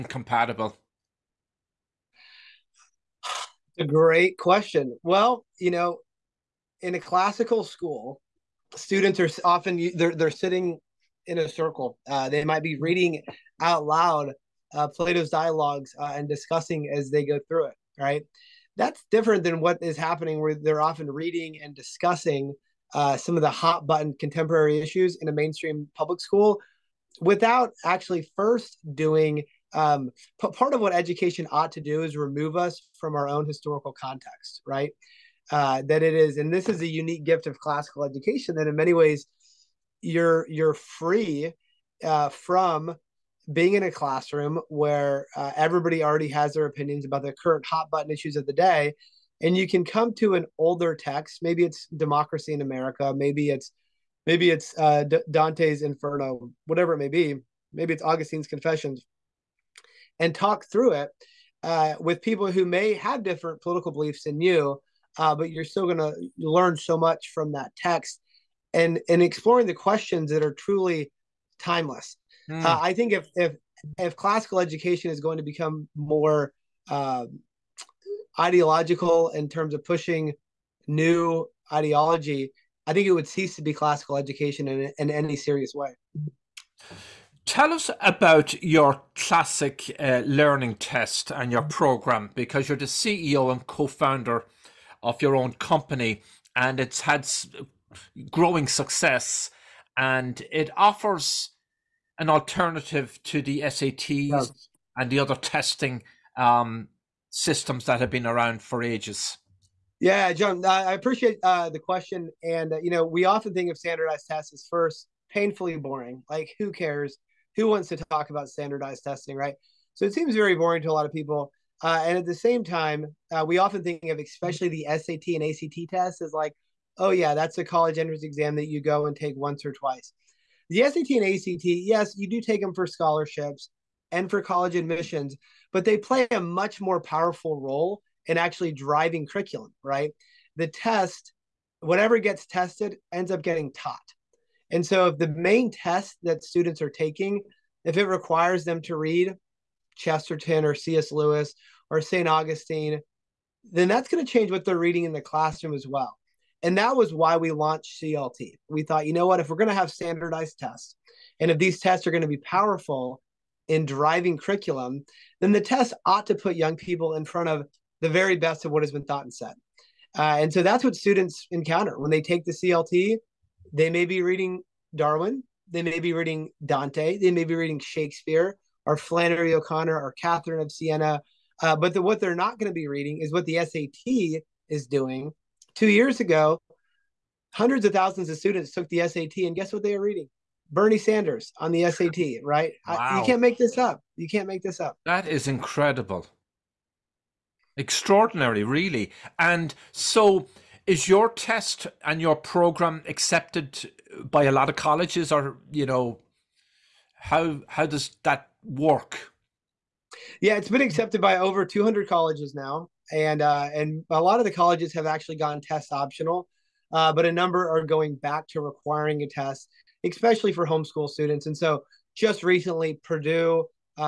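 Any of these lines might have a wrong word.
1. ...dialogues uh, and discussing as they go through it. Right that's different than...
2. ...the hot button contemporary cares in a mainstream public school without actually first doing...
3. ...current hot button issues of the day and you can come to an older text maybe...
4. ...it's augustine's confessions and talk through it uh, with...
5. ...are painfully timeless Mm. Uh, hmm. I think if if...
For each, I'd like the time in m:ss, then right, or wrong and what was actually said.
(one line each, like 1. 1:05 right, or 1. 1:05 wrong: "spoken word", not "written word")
1. 0:15 right
2. 0:23 wrong: "issues", not "cares"
3. 0:47 right
4. 0:57 right
5. 1:10 wrong: "truly", not "painfully".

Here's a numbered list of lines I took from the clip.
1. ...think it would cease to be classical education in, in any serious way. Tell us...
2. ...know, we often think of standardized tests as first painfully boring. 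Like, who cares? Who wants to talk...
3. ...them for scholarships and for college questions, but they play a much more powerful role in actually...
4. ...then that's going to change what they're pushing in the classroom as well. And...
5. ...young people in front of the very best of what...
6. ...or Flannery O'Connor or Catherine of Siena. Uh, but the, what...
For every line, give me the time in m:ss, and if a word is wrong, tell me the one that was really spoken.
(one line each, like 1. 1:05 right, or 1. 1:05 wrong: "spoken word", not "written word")
1. 1:22 right
2. 1:52 right
3. 2:12 wrong: "admissions", not "questions"
4. 2:33 wrong: "reading", not "pushing"
5. 2:46 right
6. 2:58 right.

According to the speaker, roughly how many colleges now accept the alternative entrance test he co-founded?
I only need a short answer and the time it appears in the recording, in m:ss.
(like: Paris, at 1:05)
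over 200, at 3:31.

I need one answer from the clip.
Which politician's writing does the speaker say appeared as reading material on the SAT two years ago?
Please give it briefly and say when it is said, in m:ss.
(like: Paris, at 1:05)
Bernie Sanders, at 3:10.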